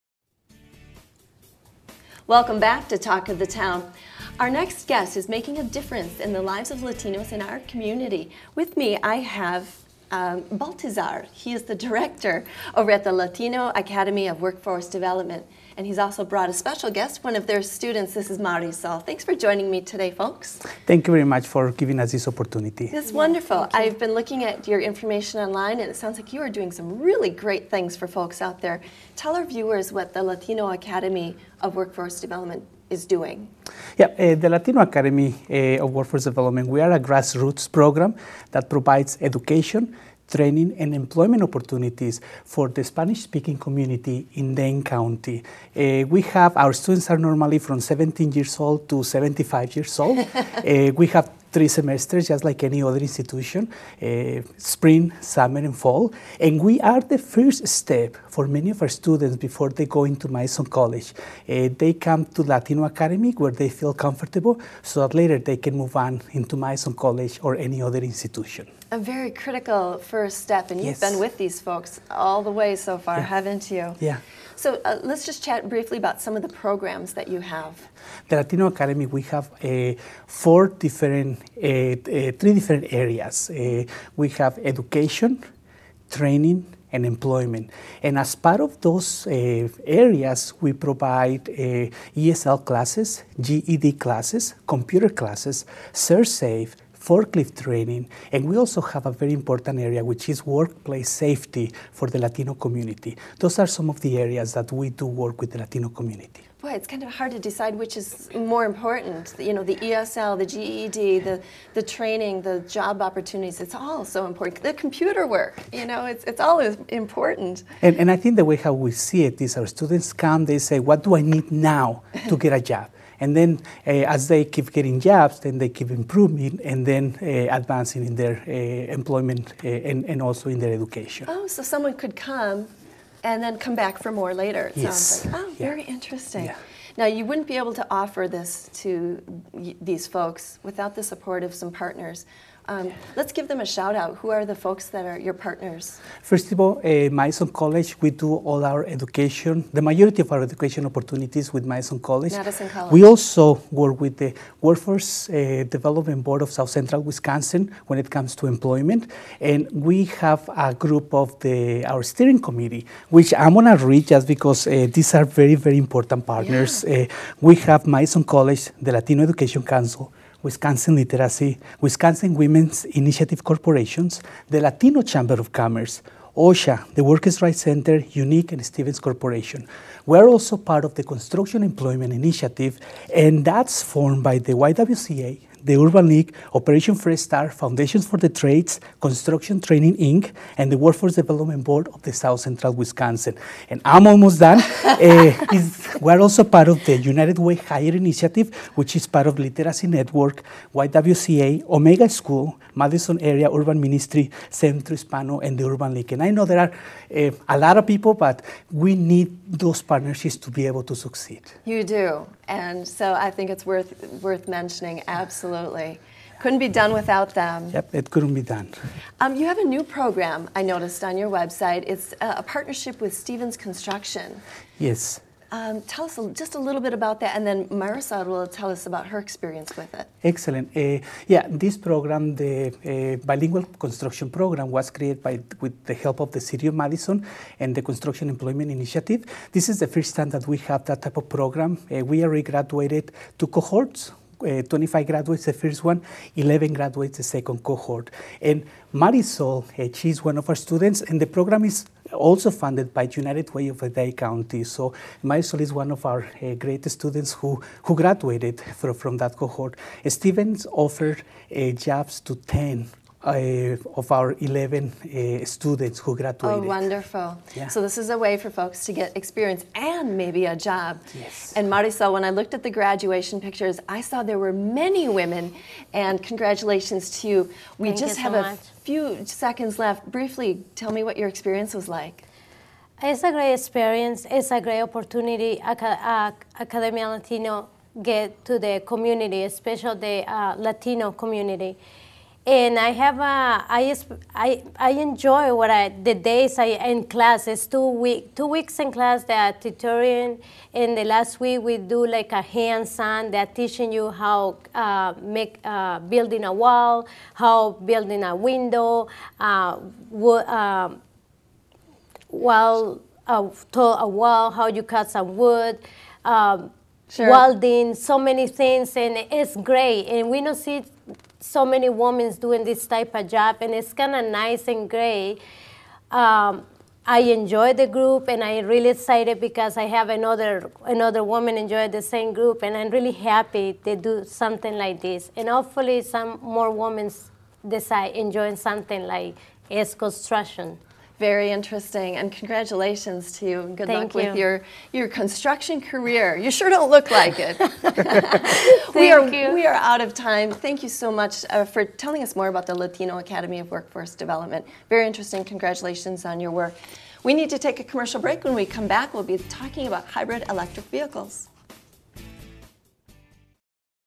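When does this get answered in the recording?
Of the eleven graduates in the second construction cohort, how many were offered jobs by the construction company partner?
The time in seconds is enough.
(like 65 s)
262 s.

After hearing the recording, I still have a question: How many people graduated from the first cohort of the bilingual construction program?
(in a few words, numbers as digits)
25.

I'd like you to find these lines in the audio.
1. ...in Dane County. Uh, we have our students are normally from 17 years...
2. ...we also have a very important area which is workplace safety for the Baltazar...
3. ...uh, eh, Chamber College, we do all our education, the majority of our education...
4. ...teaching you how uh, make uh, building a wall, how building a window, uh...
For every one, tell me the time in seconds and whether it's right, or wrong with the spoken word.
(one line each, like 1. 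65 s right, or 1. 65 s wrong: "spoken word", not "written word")
1. 44 s right
2. 98 s wrong: "Latino", not "Baltazar"
3. 146 s wrong: "Madison", not "Chamber"
4. 303 s right.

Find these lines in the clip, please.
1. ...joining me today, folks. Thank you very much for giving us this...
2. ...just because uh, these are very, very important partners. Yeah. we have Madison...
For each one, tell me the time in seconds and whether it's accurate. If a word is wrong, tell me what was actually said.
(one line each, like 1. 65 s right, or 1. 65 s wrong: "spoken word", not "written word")
1. 19 s right
2. 164 s right.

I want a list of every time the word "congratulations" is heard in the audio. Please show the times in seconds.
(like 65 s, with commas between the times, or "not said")
276 s, 342 s, 355 s.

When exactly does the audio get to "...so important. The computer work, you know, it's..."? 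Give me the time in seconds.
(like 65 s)
114 s.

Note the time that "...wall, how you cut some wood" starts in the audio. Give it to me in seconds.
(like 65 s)
314 s.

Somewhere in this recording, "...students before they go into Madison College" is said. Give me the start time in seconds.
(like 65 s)
58 s.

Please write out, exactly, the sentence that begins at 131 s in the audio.
Oh, so someone could come and then come back for more later.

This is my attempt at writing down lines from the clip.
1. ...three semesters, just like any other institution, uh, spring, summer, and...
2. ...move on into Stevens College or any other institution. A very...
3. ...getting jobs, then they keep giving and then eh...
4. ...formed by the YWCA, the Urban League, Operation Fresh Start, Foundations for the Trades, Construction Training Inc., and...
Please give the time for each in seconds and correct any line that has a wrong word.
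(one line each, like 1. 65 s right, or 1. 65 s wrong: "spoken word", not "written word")
1. 51 s right
2. 65 s wrong: "Madison", not "Stevens"
3. 124 s wrong: "improving", not "giving"
4. 183 s right.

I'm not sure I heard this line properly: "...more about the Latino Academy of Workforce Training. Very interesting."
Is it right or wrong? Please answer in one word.
wrong.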